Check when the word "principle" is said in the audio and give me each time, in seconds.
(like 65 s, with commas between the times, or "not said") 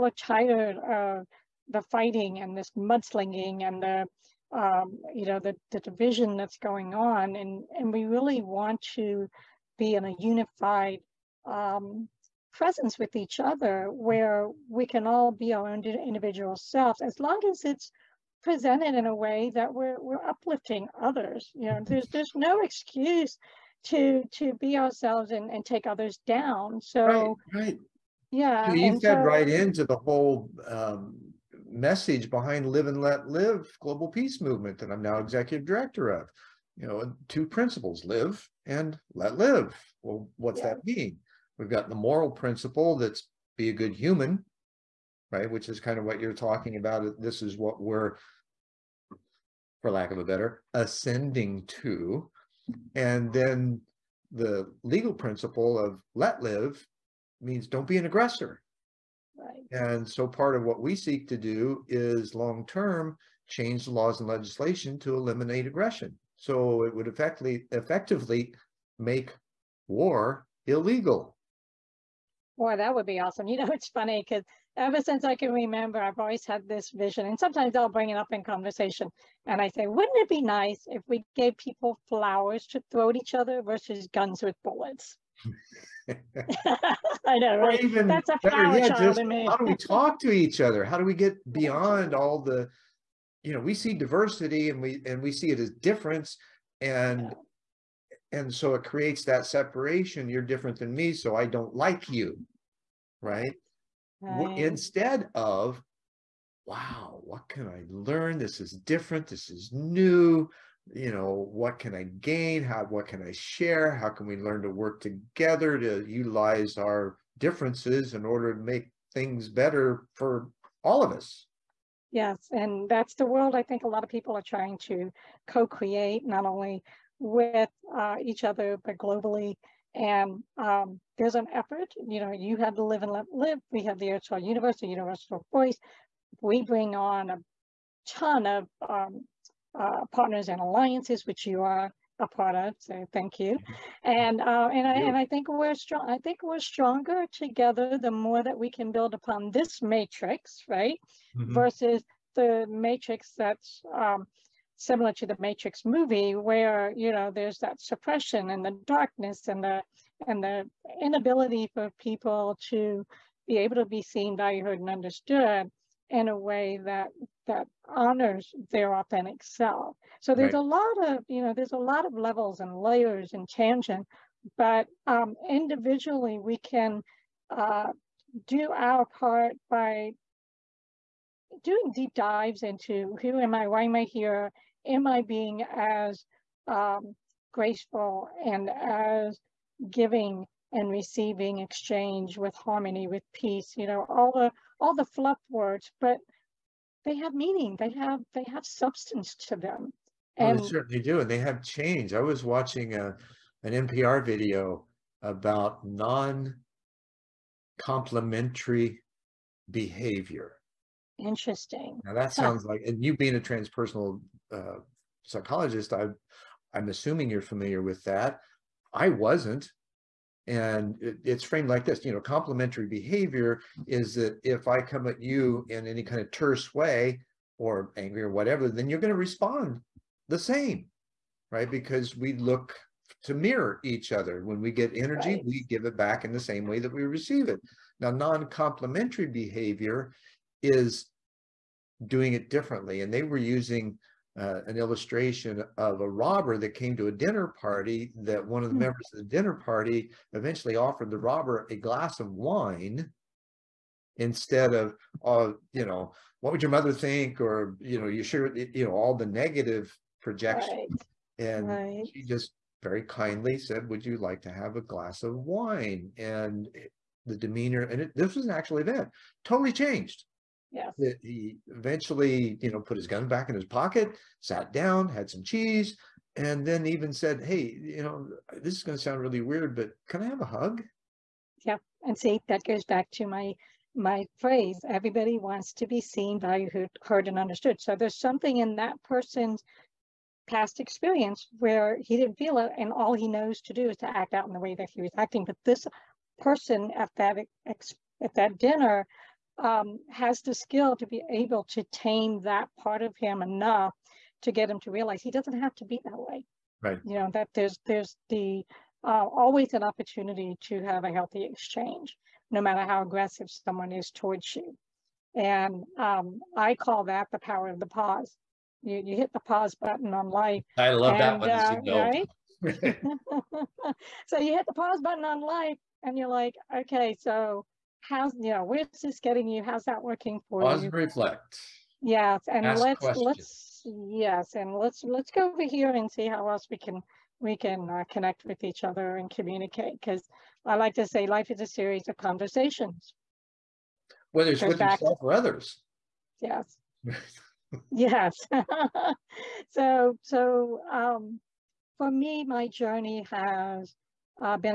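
37 s, 42 s, 55 s.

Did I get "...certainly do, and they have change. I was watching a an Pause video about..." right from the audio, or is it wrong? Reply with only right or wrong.
wrong.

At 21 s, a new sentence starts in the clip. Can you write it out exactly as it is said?
there's there's no excuse to to be ourselves and, and take others down so right, right.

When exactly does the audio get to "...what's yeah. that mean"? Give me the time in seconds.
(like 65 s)
40 s.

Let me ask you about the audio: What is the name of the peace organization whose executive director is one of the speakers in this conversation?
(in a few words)
Live and Let Live Global Peace Movement.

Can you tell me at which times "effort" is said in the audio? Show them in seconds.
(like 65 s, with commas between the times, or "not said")
131 s.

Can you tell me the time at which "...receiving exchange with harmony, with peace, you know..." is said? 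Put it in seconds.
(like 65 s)
190 s.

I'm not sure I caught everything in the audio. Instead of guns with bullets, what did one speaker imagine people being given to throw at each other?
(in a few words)
flowers.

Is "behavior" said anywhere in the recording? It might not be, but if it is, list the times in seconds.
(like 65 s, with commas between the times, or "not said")
209 s, 222 s, 239 s.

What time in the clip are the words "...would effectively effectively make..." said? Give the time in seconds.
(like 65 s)
66 s.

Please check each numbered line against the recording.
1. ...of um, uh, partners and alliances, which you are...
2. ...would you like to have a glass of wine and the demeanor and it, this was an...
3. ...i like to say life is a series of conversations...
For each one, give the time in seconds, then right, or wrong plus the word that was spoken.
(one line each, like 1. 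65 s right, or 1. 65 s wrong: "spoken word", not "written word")
1. 138 s right
2. 263 s right
3. 340 s right.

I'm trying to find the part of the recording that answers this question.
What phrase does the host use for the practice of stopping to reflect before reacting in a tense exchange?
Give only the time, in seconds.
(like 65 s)
317 s.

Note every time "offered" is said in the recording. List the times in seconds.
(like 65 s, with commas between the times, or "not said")
250 s.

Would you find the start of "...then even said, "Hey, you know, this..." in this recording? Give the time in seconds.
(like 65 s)
276 s.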